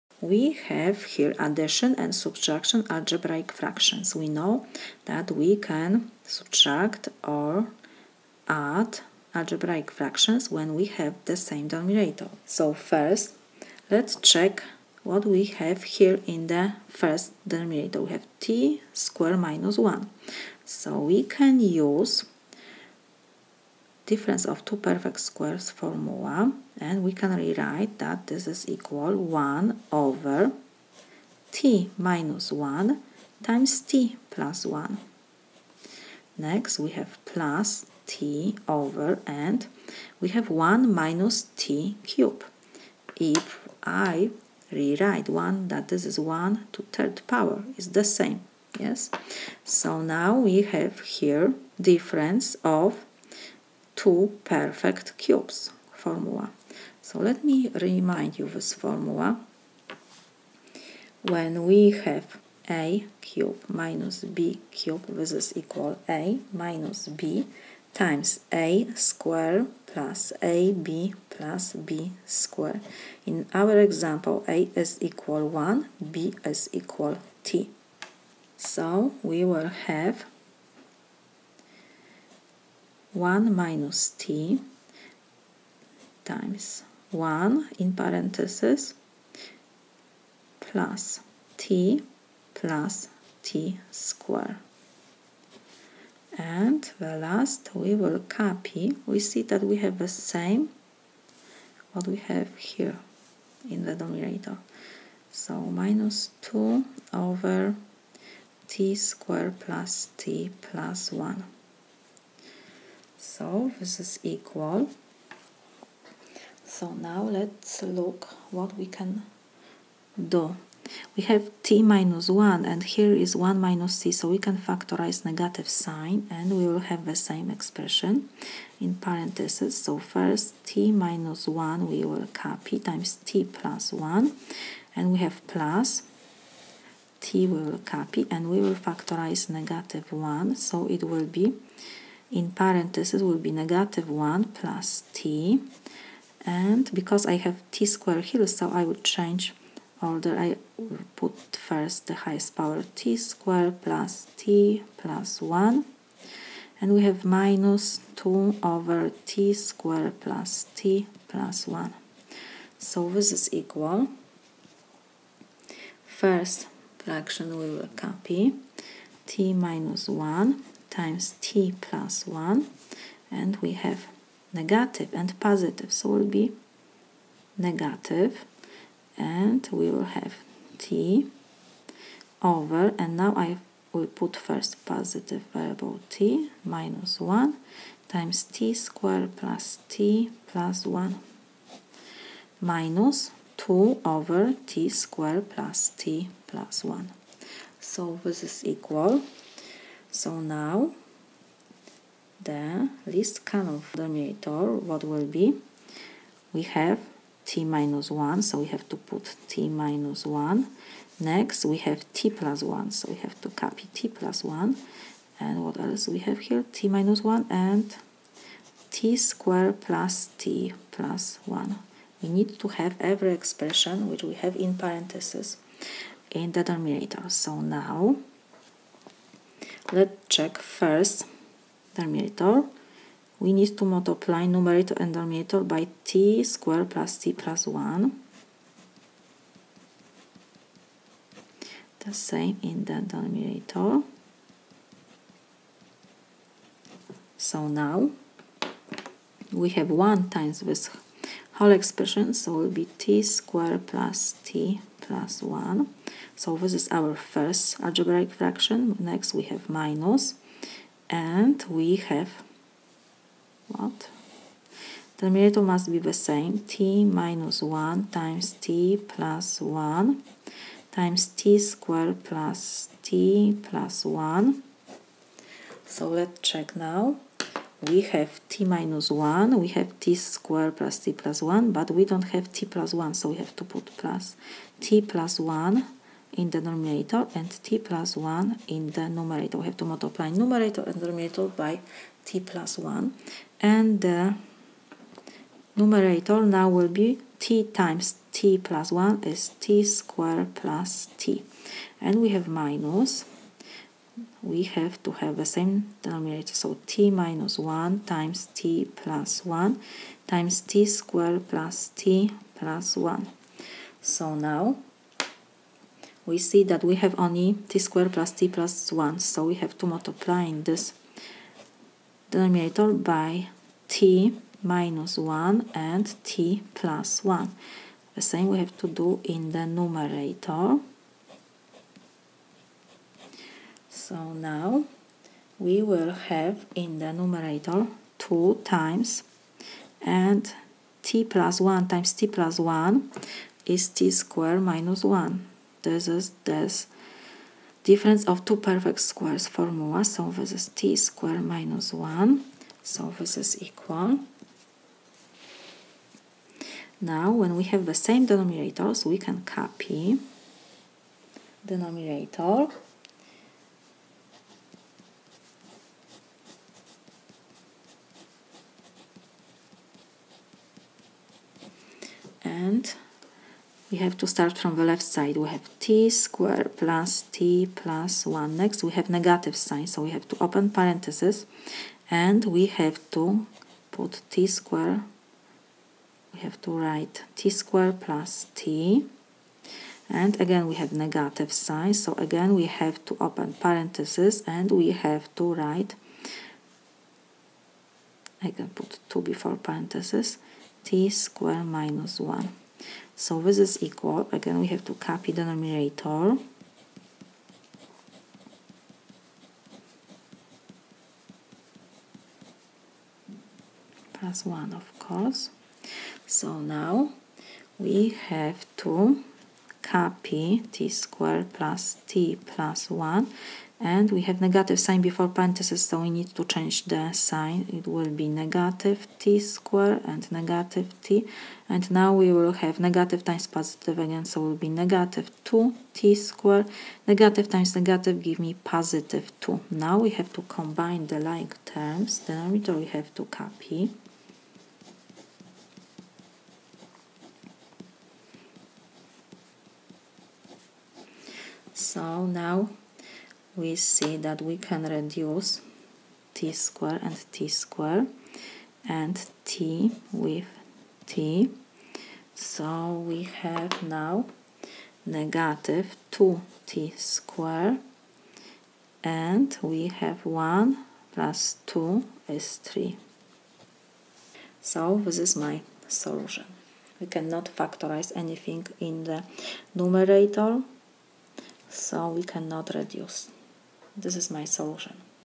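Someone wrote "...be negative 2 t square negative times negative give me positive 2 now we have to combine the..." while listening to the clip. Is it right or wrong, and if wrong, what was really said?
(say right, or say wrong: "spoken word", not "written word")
right.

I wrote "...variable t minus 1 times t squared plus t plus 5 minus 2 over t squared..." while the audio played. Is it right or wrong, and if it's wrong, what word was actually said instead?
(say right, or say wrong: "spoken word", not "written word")
wrong: "1", not "5".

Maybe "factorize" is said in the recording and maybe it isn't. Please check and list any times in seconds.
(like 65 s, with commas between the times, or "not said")
124 s, 138 s, 477 s.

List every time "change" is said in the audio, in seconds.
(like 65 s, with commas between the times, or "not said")
149 s, 426 s.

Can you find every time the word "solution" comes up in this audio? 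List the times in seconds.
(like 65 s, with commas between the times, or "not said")
475 s, 484 s.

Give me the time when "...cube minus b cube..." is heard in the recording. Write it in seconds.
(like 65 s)
63 s.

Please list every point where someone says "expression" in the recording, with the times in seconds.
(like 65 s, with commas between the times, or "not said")
127 s, 223 s, 251 s.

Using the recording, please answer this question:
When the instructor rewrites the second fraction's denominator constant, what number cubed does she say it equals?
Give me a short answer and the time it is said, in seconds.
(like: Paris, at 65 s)
1, at 46 s.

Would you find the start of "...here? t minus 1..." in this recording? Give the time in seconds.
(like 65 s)
216 s.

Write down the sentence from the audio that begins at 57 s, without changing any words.
So let me remind you this formula.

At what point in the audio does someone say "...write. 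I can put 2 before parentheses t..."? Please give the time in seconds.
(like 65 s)
395 s.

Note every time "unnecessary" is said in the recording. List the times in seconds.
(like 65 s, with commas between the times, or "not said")
not said.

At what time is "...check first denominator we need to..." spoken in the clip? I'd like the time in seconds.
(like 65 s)
230 s.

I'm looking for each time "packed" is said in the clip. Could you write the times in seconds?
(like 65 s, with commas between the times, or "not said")
not said.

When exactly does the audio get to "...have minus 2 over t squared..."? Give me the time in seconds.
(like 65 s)
157 s.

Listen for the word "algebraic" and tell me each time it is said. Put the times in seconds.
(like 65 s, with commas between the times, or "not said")
2 s, 9 s, 257 s.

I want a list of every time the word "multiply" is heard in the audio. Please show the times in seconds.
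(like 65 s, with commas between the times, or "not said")
233 s, 289 s, 319 s.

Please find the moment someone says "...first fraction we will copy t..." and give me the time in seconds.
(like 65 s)
166 s.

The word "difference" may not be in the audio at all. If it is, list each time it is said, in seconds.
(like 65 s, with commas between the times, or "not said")
24 s, 51 s, 347 s.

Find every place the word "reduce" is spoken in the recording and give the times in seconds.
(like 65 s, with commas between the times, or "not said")
454 s, 482 s.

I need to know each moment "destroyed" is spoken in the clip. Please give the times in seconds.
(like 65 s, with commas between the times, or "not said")
not said.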